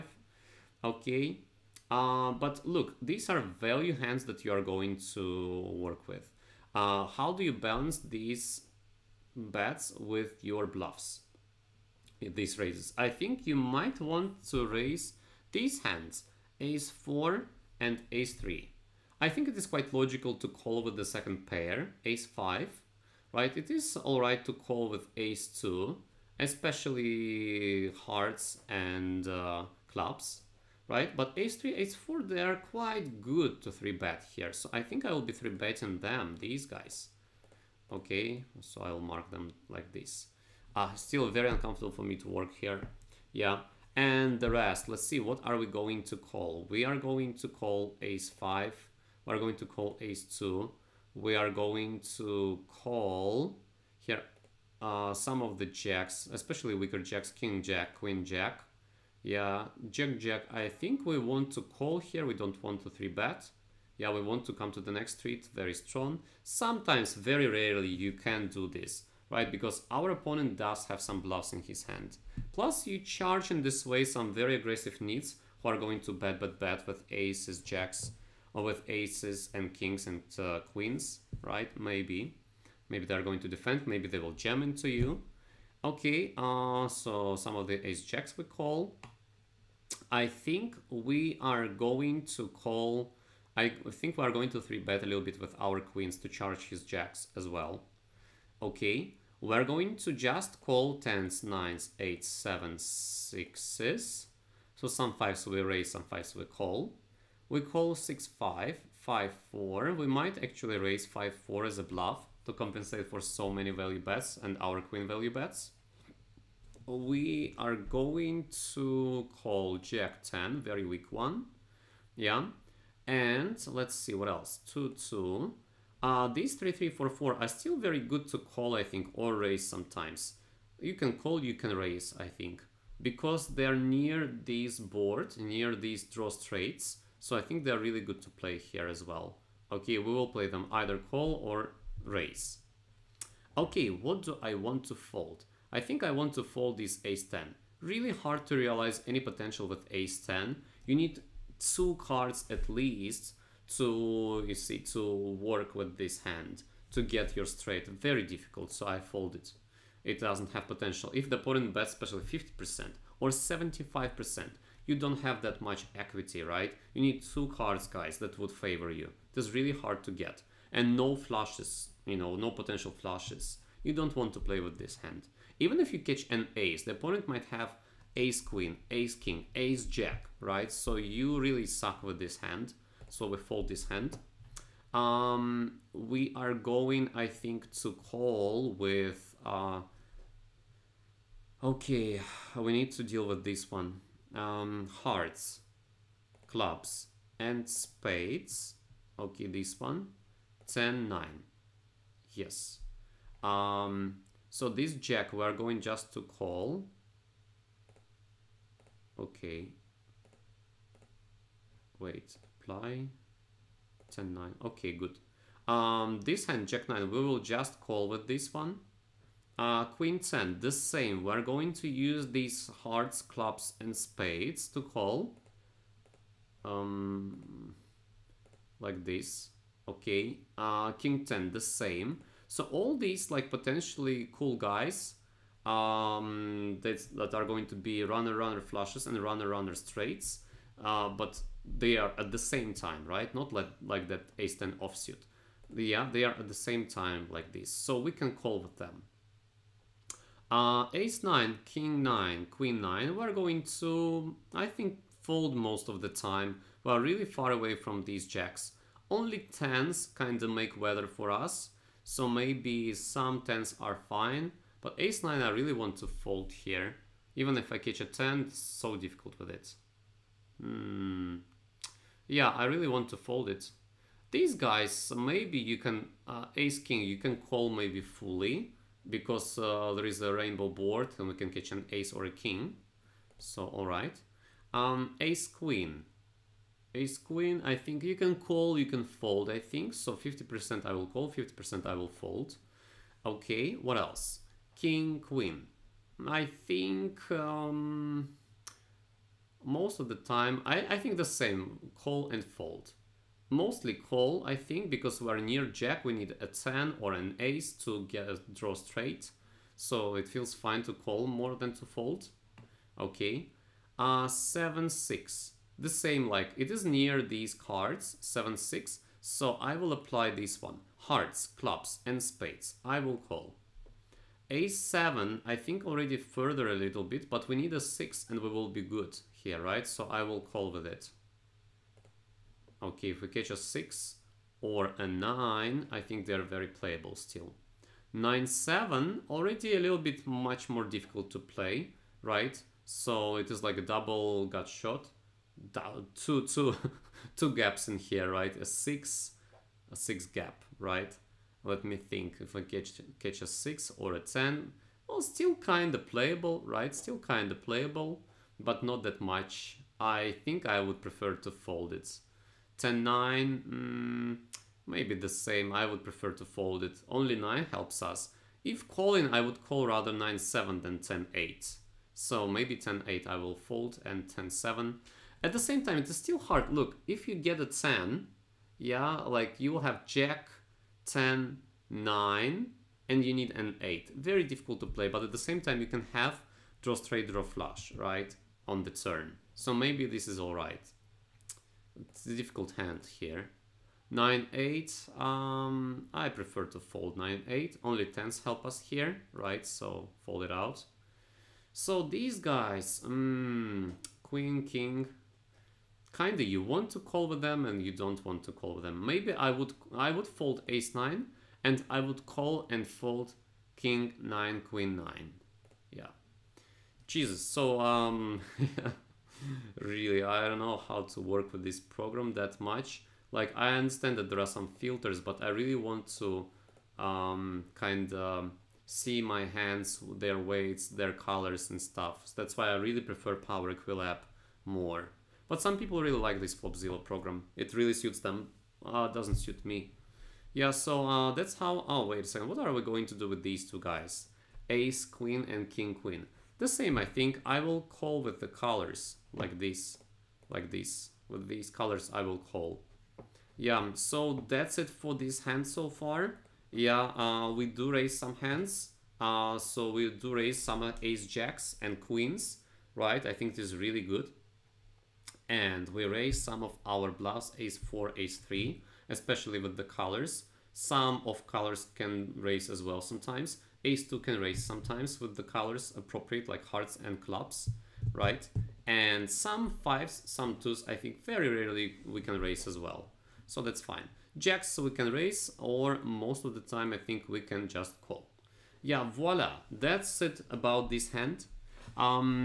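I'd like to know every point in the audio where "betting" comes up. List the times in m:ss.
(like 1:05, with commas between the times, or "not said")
0:35.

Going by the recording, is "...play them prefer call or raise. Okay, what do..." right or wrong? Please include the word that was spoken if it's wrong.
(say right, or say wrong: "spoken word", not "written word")
wrong: "either", not "prefer".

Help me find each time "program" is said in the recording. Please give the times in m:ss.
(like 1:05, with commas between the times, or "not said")
7:01, 7:17.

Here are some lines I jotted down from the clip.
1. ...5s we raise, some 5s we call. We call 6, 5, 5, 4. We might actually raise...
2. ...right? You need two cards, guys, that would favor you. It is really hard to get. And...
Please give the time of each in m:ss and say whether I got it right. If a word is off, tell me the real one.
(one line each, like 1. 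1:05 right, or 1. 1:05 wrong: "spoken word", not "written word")
1. 1:45 right
2. 2:46 right.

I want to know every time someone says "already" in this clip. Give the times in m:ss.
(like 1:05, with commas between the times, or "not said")
5:25, 5:39.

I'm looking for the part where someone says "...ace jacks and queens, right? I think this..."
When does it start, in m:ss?
7:41.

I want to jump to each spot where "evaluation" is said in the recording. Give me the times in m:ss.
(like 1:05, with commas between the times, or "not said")
not said.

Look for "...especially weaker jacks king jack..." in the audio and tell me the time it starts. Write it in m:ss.
0:56.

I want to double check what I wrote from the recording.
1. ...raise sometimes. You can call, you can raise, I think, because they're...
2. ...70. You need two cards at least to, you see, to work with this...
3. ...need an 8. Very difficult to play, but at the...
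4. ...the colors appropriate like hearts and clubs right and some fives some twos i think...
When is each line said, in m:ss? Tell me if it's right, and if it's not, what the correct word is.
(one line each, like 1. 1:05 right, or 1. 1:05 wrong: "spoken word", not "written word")
1. 2:09 right
2. 2:30 wrong: "10", not "70"
3. 6:23 right
4. 7:55 right.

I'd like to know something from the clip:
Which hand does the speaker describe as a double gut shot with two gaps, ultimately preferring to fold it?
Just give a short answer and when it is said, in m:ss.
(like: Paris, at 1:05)
9-7, at 5:38.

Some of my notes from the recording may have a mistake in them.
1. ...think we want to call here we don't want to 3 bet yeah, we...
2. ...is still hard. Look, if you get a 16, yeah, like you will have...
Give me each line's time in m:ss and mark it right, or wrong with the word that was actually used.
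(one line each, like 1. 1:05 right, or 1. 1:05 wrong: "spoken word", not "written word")
1. 1:00 right
2. 6:16 wrong: "10", not "16".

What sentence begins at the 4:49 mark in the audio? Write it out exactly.
So 50% I will call, 50% I will fold.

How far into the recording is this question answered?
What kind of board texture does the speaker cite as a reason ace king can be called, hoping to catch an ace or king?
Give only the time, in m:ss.
4:40.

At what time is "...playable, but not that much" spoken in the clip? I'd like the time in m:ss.
5:57.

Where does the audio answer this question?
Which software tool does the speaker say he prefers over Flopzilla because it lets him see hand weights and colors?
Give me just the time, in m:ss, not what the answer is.
7:13.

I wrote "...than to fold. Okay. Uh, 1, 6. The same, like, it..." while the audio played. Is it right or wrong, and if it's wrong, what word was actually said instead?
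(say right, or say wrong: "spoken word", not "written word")
wrong: "7", not "1".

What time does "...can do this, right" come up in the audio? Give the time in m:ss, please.
1:08.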